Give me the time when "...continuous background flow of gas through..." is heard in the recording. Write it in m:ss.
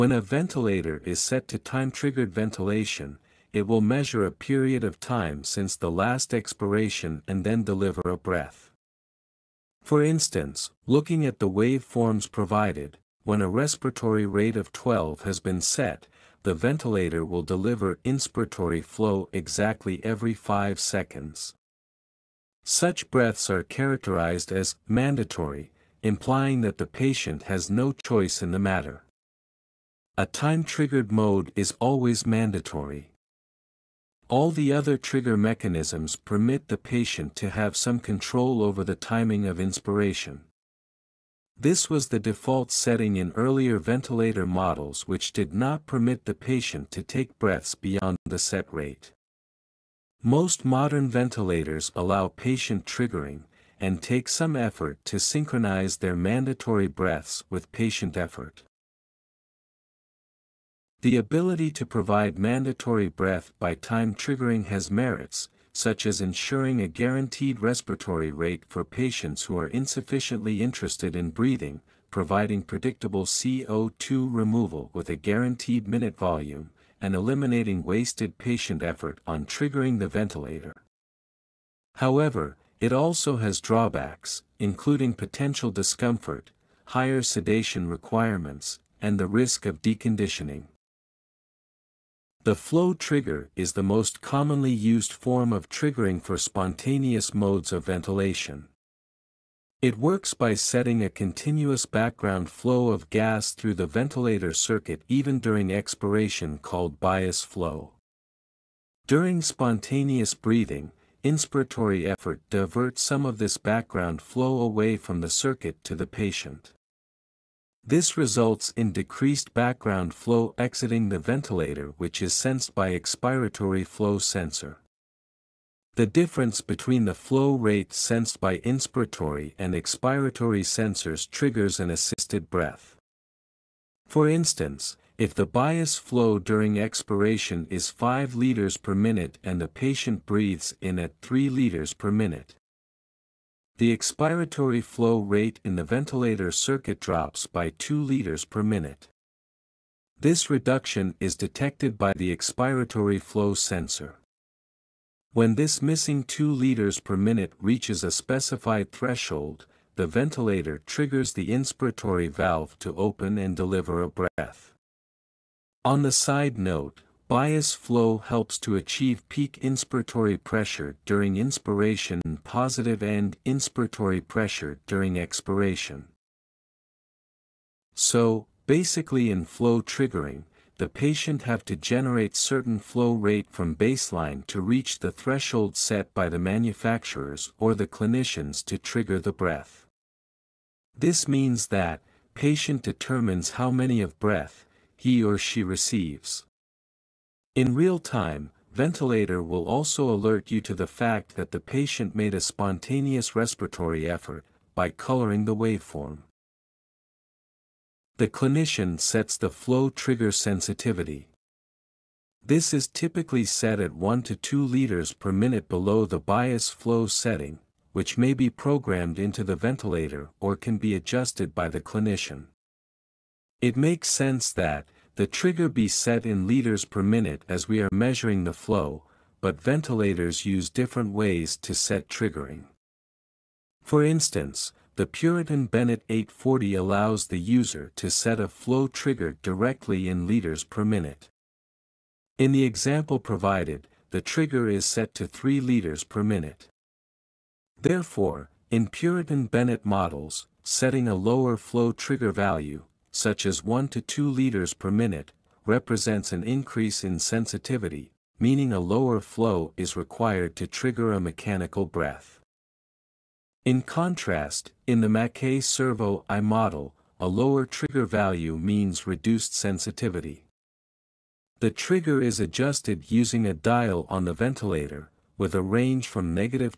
1:41.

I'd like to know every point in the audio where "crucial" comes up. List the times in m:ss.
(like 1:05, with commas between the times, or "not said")
not said.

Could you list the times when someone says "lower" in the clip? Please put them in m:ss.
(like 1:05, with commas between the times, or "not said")
4:11, 4:18, 4:27.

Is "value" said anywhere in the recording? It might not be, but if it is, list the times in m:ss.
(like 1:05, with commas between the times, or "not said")
4:12, 4:28.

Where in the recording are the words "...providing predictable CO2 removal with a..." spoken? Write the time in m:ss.
1:12.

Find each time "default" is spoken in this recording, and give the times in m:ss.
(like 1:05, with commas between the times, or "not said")
0:42.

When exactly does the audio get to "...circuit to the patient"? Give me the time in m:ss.
1:55.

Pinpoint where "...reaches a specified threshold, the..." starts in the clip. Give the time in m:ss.
2:37.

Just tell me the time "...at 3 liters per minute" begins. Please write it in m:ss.
2:21.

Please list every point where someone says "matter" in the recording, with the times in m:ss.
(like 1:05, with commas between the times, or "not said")
0:28.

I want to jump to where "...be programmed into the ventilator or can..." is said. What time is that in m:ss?
3:38.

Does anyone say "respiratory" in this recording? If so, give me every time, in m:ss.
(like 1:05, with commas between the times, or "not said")
0:13, 1:07, 3:23.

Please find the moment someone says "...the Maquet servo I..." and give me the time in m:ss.
4:25.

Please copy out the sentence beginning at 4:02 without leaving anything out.
In the example provided, the trigger is set to 3 liters per minute.